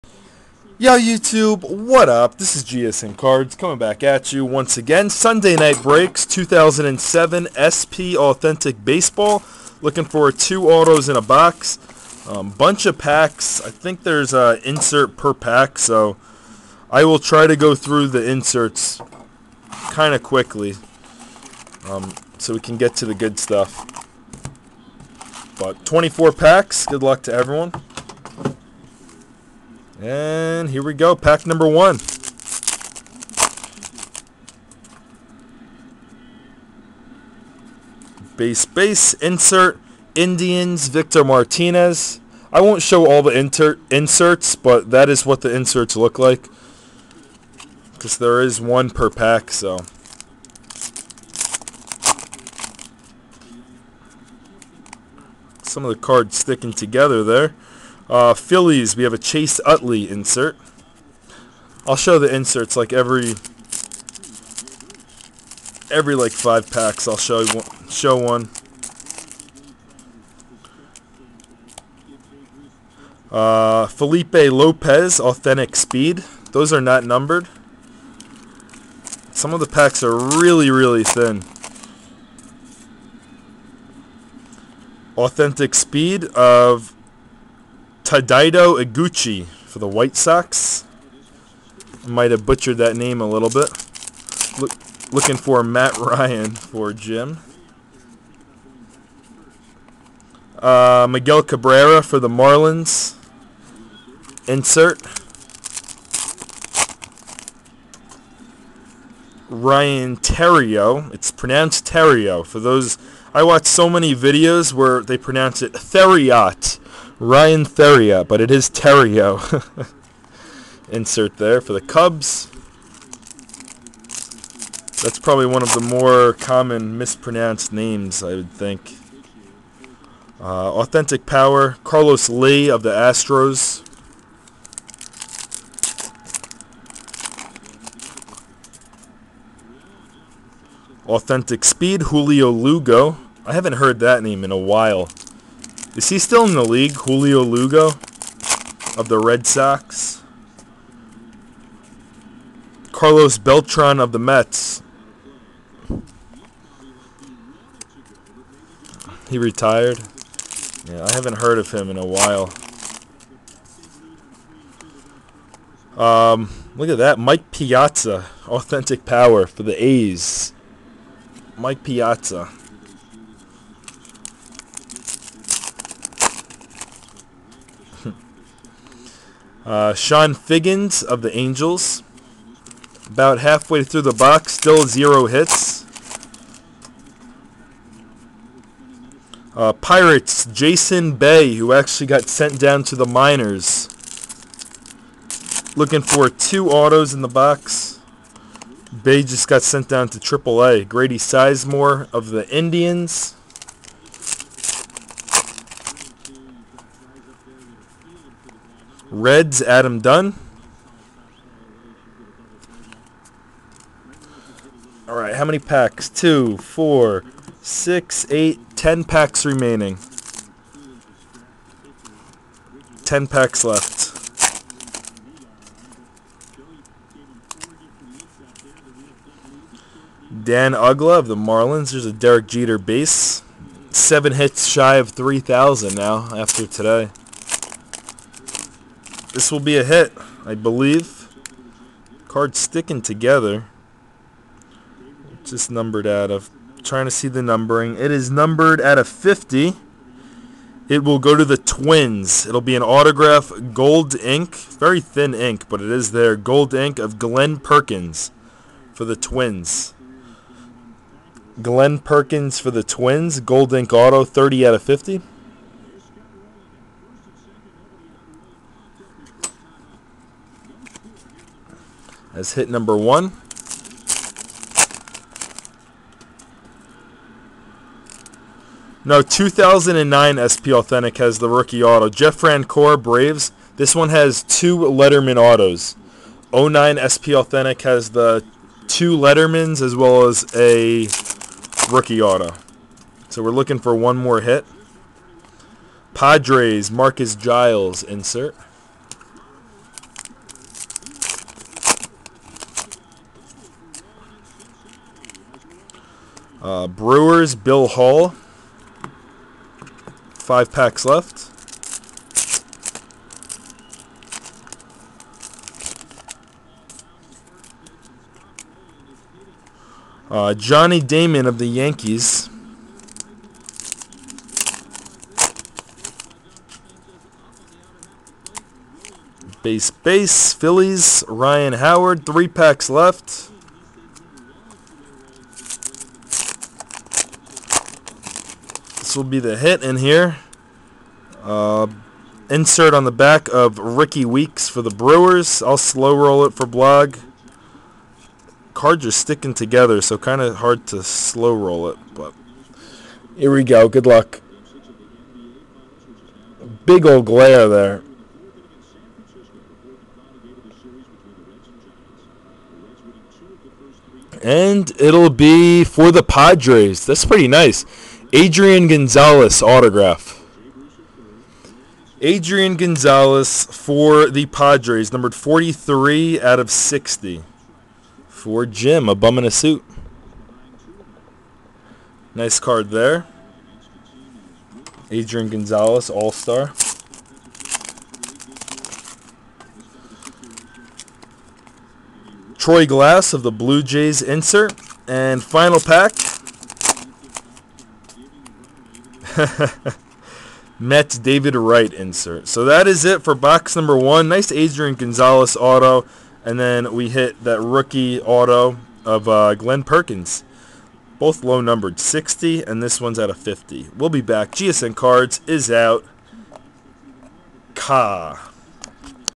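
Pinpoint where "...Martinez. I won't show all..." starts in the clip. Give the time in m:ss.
0:41.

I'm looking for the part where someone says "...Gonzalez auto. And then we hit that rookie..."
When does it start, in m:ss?
6:44.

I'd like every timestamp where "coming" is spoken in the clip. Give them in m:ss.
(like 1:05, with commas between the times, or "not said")
0:03.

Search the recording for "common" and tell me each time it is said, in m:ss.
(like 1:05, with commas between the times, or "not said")
2:06.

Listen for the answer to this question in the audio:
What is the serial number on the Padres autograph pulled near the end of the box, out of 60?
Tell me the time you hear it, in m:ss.
6:15.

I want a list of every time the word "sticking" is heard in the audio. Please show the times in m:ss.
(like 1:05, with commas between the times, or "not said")
0:56, 4:02, 5:49.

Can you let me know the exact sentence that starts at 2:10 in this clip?
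Uh, authentic Power, Carlos Lee of the Astros.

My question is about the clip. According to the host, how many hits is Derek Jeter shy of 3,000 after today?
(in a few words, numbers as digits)
7.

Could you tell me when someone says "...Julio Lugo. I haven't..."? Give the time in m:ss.
2:22.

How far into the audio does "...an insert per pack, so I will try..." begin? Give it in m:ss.
0:14.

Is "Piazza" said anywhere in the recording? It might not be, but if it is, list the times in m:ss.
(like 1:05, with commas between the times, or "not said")
2:47, 2:51.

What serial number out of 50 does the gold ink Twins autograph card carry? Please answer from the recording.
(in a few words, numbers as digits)
30.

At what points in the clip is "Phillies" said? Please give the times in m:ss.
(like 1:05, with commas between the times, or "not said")
0:58, 5:30.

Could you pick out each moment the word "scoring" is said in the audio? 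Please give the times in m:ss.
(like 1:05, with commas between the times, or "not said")
not said.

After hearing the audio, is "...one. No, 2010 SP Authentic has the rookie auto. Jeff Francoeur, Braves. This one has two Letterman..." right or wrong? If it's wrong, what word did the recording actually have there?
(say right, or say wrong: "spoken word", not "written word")
wrong: "2009", not "2010".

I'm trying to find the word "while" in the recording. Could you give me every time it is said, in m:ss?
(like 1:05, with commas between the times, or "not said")
2:24, 2:42.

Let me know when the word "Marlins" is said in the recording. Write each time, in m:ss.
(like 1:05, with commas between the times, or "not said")
1:42, 3:51.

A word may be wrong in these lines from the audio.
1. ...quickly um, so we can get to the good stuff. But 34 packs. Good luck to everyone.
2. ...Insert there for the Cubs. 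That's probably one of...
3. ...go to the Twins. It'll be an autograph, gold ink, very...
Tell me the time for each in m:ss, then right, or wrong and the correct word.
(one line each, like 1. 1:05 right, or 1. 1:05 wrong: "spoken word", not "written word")
1. 0:20 wrong: "24", not "34"
2. 2:00 right
3. 4:11 right.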